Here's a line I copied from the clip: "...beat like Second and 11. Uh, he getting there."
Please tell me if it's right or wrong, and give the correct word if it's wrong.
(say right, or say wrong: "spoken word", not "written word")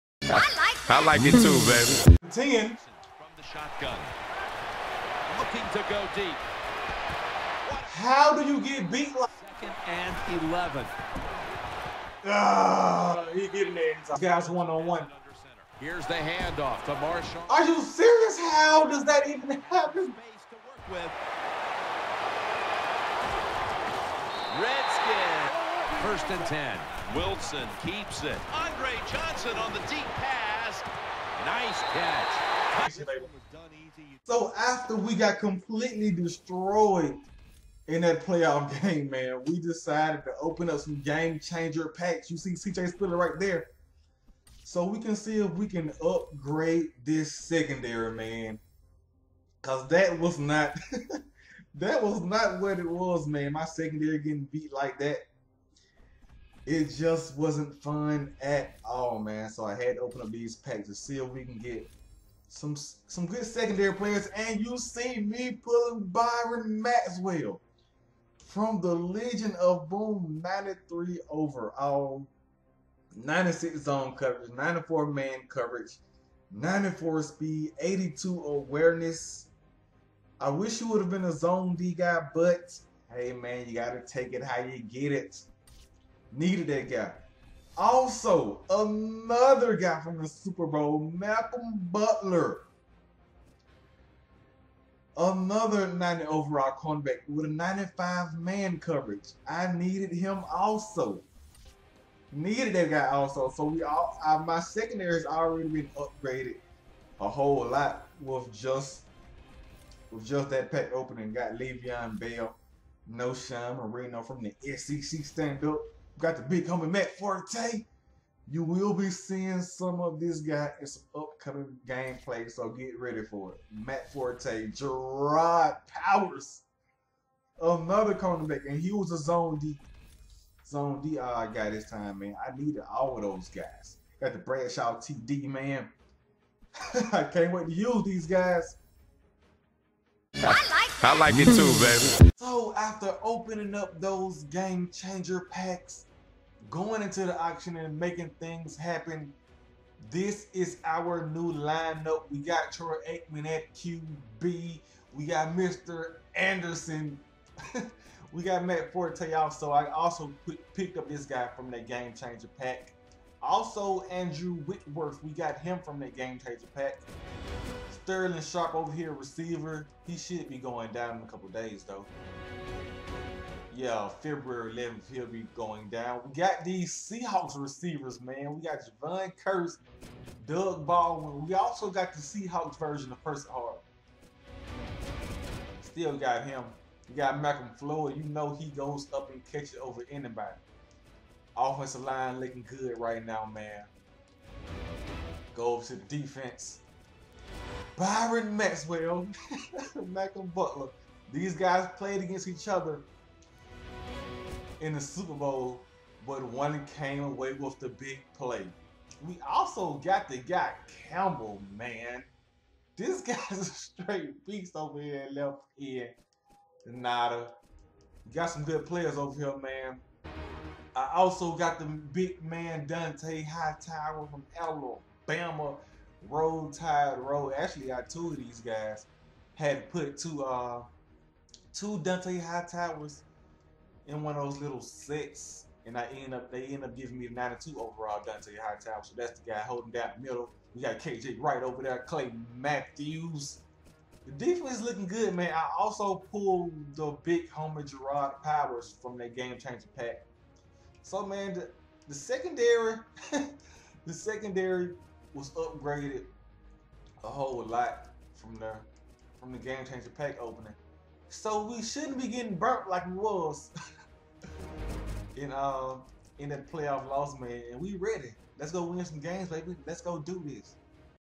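right.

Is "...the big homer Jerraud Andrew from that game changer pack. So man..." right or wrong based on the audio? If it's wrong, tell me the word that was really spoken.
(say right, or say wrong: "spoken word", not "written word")
wrong: "Powers", not "Andrew".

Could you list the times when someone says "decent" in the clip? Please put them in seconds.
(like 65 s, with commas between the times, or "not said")
not said.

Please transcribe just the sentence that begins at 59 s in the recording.
So I had to open up these packs to see if we can get some some good secondary players.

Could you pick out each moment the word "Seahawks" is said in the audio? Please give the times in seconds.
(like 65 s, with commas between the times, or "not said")
176 s, 182 s.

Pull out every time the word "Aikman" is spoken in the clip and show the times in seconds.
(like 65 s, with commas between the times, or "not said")
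153 s.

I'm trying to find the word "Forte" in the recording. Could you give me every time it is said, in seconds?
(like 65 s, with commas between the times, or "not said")
117 s, 124 s, 158 s.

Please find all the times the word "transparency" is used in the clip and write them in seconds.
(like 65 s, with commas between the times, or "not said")
not said.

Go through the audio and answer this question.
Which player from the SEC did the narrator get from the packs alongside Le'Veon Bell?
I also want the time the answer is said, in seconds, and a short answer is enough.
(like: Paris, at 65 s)
Knowshon Moreno, at 113 s.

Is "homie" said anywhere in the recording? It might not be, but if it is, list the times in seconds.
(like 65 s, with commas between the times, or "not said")
116 s.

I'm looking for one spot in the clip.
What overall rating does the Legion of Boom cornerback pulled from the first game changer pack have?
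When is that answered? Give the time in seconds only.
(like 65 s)
70 s.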